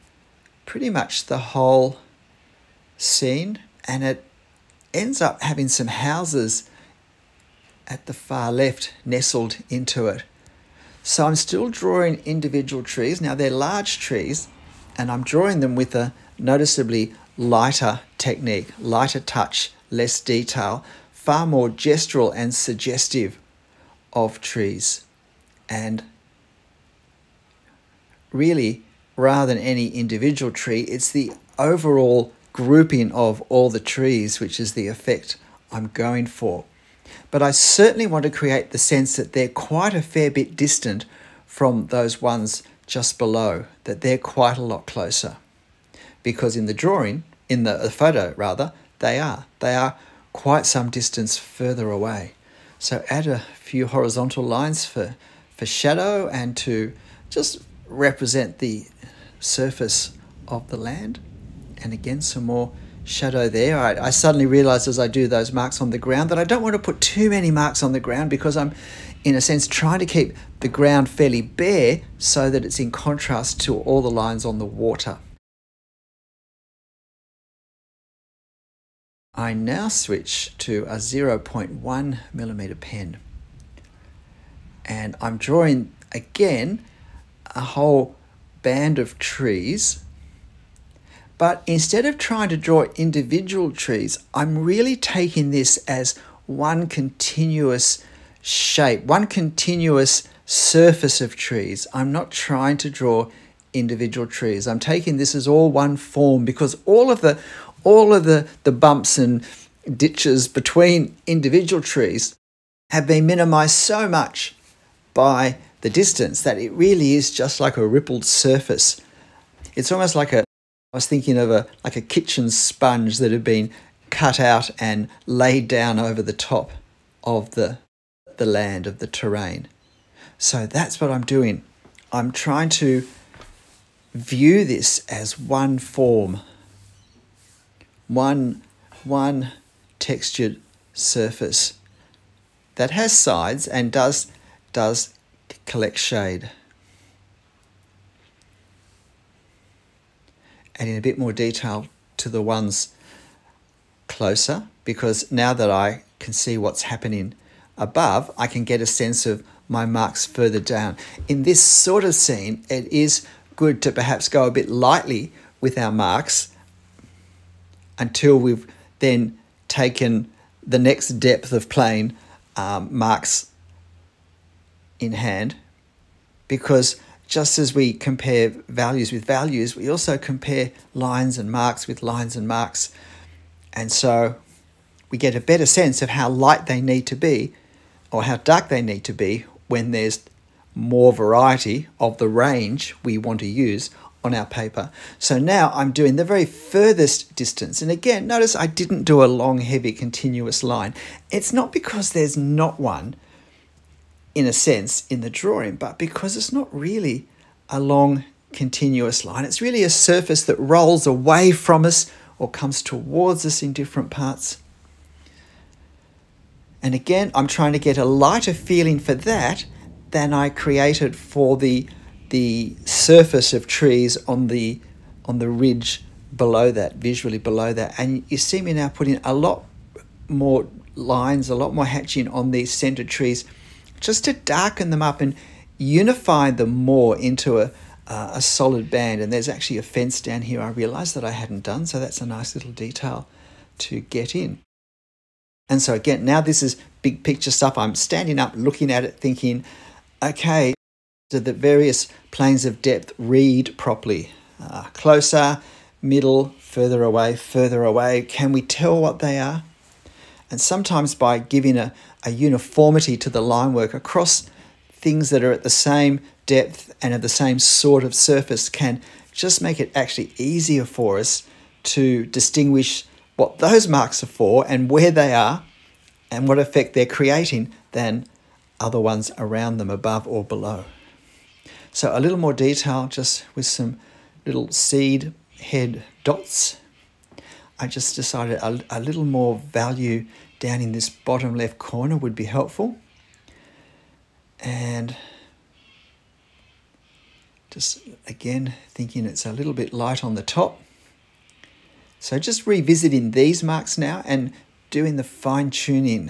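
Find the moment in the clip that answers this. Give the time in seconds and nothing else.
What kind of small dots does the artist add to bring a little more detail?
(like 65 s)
284 s.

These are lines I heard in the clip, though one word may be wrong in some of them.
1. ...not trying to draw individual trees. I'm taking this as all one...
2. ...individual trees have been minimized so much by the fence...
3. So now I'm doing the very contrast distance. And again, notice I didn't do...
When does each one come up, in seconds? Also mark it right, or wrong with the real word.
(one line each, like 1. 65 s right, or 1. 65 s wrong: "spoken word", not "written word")
1. 102 s right
2. 111 s wrong: "distance", not "fence"
3. 195 s wrong: "furthest", not "contrast".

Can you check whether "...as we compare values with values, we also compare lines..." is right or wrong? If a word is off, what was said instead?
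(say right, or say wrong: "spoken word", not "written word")
right.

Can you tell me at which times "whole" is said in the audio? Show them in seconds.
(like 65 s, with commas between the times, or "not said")
1 s, 87 s.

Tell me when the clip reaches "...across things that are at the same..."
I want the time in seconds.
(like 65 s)
263 s.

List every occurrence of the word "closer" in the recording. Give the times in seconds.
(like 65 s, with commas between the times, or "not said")
44 s, 154 s, 254 s.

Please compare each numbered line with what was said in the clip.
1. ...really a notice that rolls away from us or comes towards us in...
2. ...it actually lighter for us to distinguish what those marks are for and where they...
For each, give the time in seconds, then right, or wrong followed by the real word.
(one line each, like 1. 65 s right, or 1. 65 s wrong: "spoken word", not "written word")
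1. 209 s wrong: "surface", not "notice"
2. 269 s wrong: "easier", not "lighter".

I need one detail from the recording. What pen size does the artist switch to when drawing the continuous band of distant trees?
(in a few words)
0.1 millimeter.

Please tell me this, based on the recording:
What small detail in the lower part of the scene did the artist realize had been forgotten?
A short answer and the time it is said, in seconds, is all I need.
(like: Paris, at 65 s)
A fence, at 239 s.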